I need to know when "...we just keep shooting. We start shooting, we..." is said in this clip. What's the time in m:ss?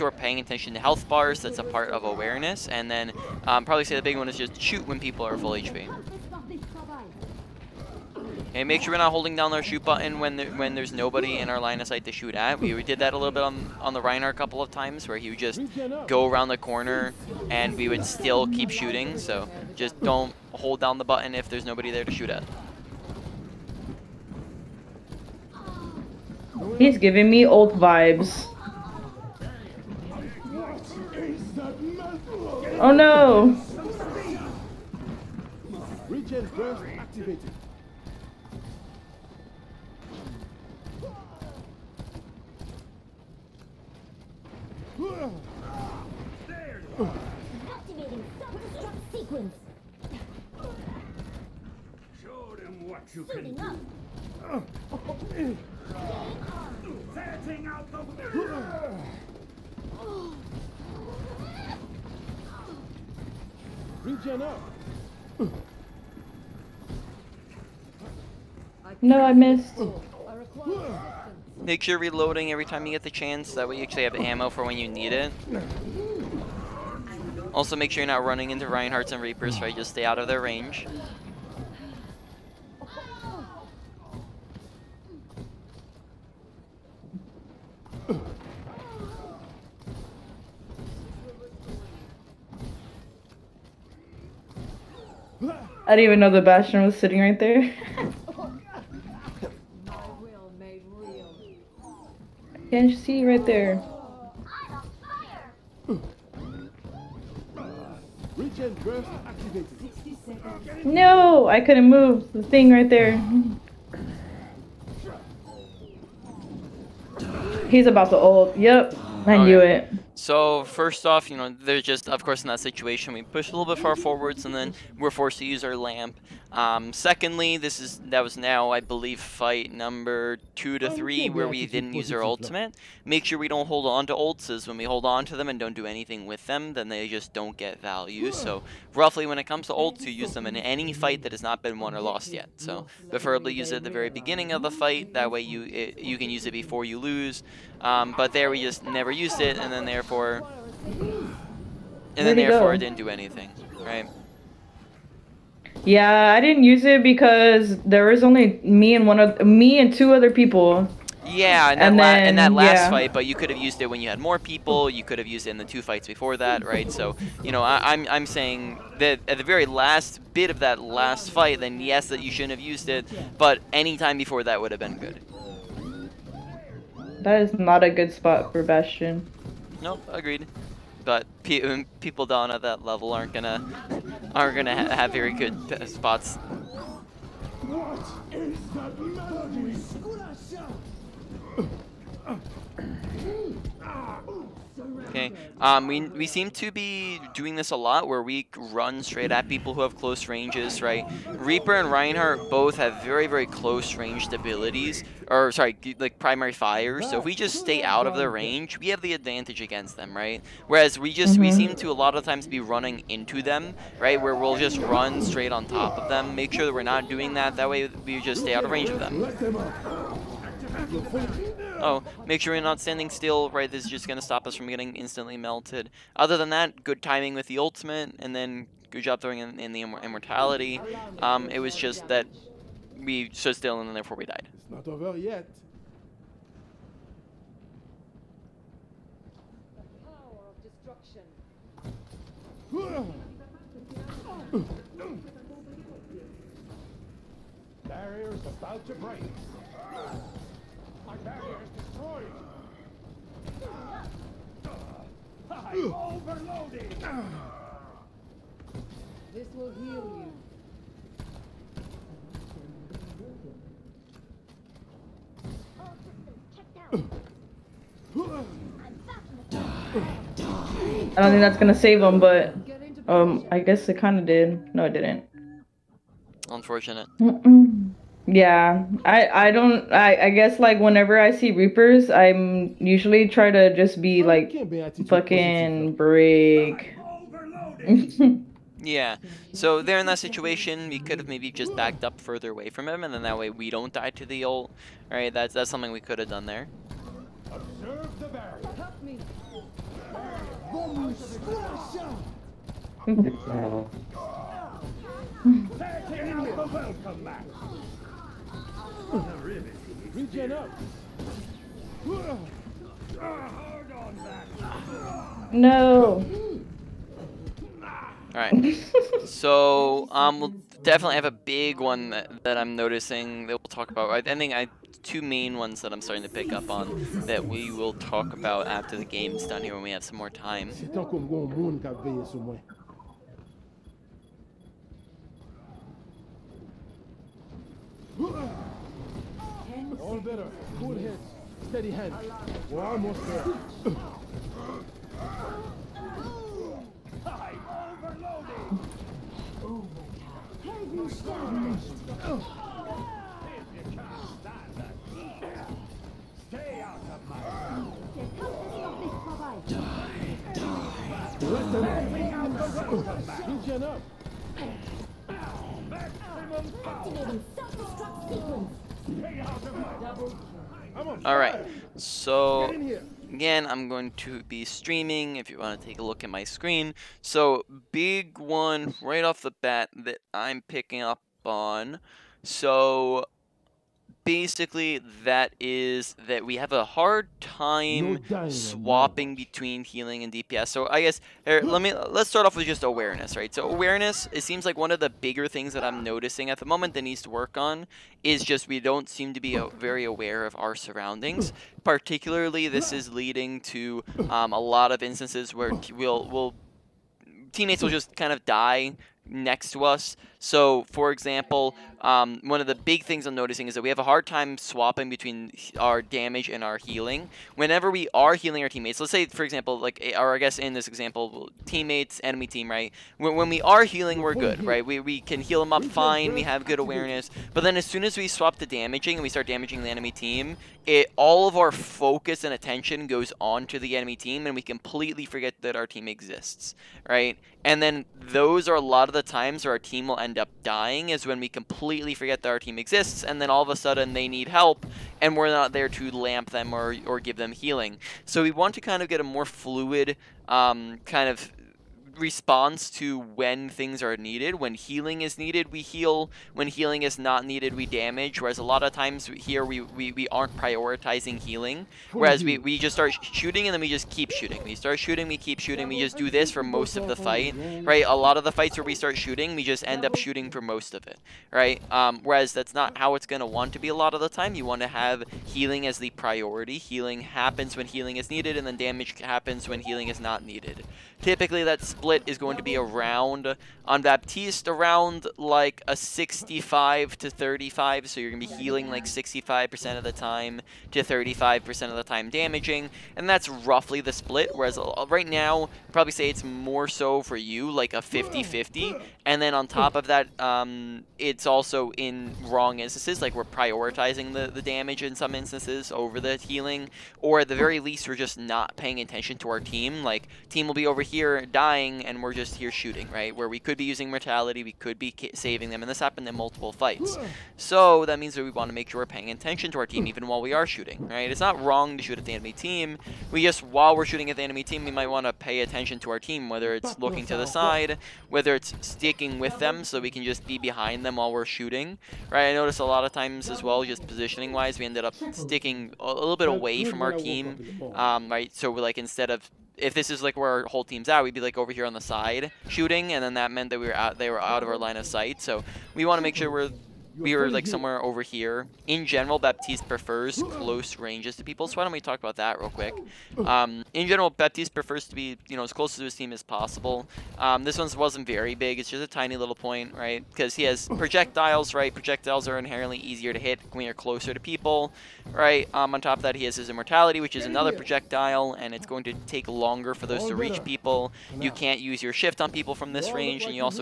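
7:43.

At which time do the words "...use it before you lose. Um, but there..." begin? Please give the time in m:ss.
2:26.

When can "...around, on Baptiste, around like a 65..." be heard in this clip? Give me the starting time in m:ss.
8:02.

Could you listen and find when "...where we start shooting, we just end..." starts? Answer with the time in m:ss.
7:48.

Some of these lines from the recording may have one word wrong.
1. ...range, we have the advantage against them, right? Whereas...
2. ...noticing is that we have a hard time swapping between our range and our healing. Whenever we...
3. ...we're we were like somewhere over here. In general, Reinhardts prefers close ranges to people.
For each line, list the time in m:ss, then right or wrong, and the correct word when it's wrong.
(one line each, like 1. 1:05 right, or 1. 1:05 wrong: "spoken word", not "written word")
1. 3:28 right
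2. 6:53 wrong: "damage", not "range"
3. 9:06 wrong: "Baptiste", not "Reinhardts".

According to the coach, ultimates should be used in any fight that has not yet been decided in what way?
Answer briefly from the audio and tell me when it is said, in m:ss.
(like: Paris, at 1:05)
won or lost, at 2:21.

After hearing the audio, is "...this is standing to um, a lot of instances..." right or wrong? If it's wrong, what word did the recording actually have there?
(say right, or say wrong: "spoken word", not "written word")
wrong: "leading", not "standing".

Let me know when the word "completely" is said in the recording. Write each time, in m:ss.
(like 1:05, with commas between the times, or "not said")
7:14, 7:21.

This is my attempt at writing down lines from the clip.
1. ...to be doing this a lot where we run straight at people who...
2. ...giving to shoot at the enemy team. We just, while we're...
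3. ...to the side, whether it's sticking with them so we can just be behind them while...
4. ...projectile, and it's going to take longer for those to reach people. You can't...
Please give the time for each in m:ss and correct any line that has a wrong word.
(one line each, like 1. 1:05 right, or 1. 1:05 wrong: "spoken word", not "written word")
1. 3:16 right
2. 8:41 wrong: "wrong", not "giving"
3. 8:47 right
4. 9:27 right.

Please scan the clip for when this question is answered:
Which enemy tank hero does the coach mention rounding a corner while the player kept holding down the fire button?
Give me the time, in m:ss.
0:14.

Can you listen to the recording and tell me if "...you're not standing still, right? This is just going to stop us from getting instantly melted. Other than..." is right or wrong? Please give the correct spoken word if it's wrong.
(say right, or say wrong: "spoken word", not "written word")
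right.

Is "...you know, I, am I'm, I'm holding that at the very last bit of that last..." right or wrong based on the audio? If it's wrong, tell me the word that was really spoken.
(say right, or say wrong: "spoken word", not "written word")
wrong: "saying", not "holding".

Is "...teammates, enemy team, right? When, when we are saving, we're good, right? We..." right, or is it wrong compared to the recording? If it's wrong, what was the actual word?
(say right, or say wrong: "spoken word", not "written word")
wrong: "healing", not "saving".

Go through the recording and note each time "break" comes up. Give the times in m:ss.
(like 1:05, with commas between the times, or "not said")
4:08, 4:45.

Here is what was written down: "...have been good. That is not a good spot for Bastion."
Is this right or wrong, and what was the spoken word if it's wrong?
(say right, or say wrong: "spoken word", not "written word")
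right.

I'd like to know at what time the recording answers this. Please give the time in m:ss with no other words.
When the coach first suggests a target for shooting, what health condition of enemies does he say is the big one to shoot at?
0:05.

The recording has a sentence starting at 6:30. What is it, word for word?
So I guess here, let me let's start off with just awareness, right?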